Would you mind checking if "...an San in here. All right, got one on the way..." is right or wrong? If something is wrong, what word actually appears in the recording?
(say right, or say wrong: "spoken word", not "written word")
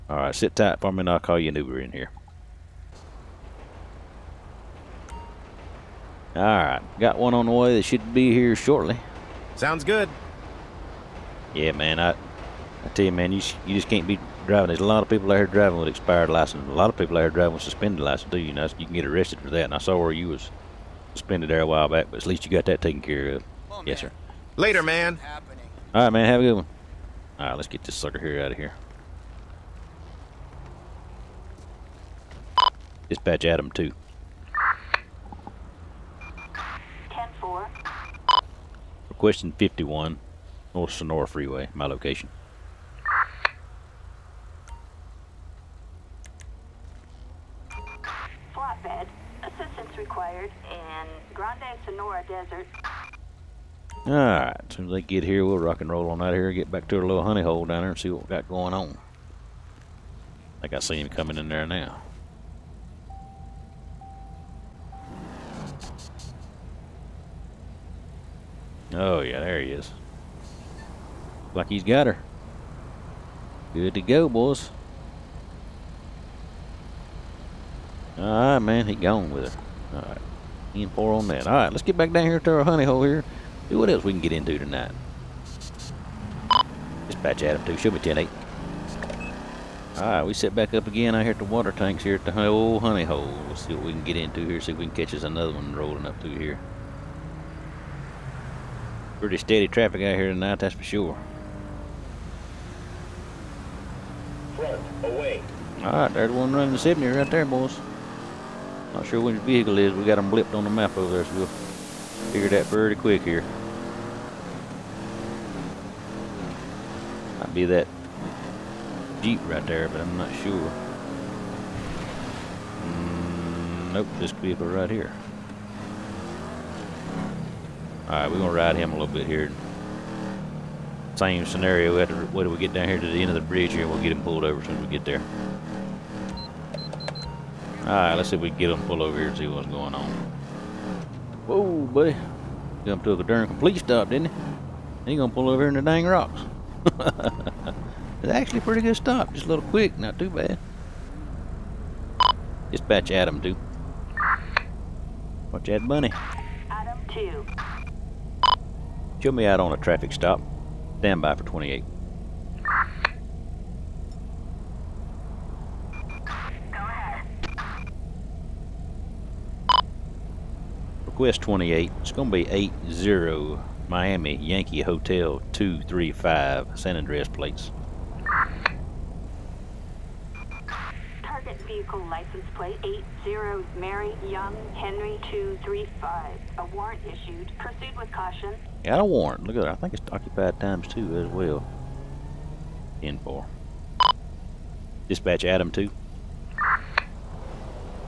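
wrong: "Uber", not "San".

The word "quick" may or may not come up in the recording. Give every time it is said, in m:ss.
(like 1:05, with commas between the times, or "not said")
1:52, 2:29.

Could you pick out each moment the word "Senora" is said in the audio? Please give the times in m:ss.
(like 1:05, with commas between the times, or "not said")
0:40, 0:51.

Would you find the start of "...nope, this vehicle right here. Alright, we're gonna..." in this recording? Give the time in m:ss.
2:03.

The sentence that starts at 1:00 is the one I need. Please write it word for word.
Like I see him coming in there now.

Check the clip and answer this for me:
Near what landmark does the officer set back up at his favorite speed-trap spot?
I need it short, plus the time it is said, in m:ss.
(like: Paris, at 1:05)
Water tanks, at 1:31.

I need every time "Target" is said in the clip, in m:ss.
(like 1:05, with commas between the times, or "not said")
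3:01.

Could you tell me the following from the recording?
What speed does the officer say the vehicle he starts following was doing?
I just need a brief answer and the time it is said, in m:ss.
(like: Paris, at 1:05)
70, at 1:46.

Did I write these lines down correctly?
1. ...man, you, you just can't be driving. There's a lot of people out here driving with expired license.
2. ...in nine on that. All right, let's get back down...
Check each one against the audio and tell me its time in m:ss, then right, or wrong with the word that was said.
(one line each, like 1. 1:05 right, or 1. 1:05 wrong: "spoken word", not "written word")
1. 0:13 right
2. 1:20 wrong: "four", not "nine".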